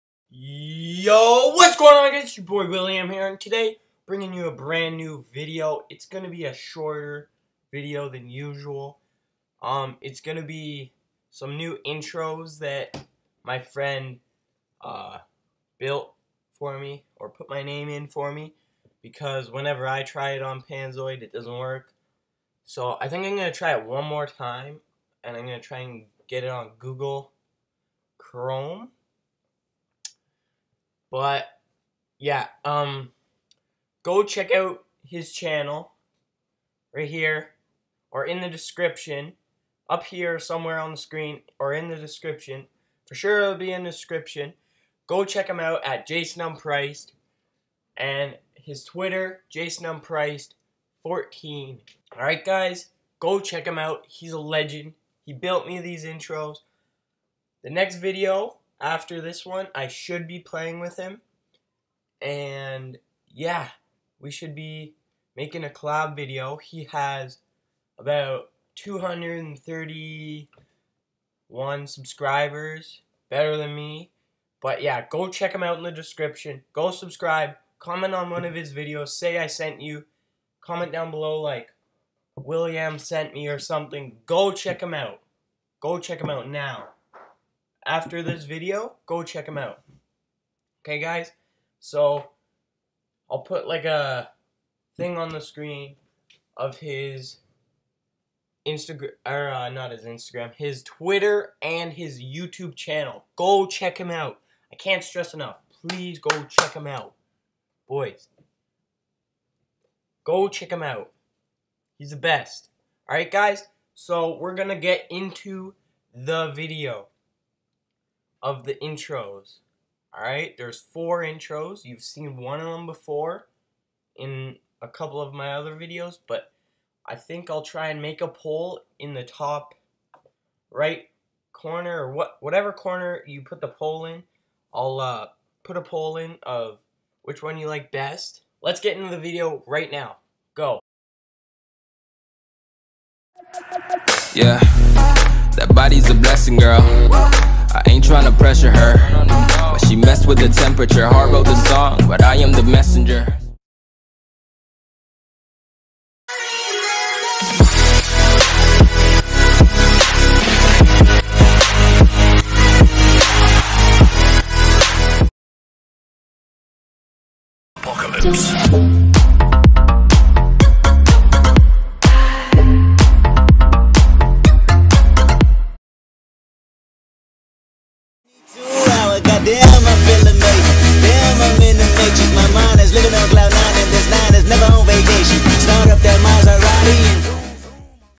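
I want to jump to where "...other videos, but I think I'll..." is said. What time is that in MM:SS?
02:05.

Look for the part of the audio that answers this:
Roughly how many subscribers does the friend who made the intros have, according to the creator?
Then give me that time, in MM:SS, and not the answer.
01:08.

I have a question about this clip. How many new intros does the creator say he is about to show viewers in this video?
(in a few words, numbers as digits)
4.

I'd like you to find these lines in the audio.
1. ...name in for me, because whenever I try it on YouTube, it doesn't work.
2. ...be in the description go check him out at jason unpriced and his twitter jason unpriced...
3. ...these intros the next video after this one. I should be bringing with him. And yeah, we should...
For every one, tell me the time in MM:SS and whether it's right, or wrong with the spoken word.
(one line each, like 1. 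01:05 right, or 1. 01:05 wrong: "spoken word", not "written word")
1. 00:17 wrong: "Panzoid", not "YouTube"
2. 00:43 right
3. 00:55 wrong: "playing", not "bringing".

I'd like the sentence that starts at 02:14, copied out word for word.
I'll uh, put a poll in of which one you like best.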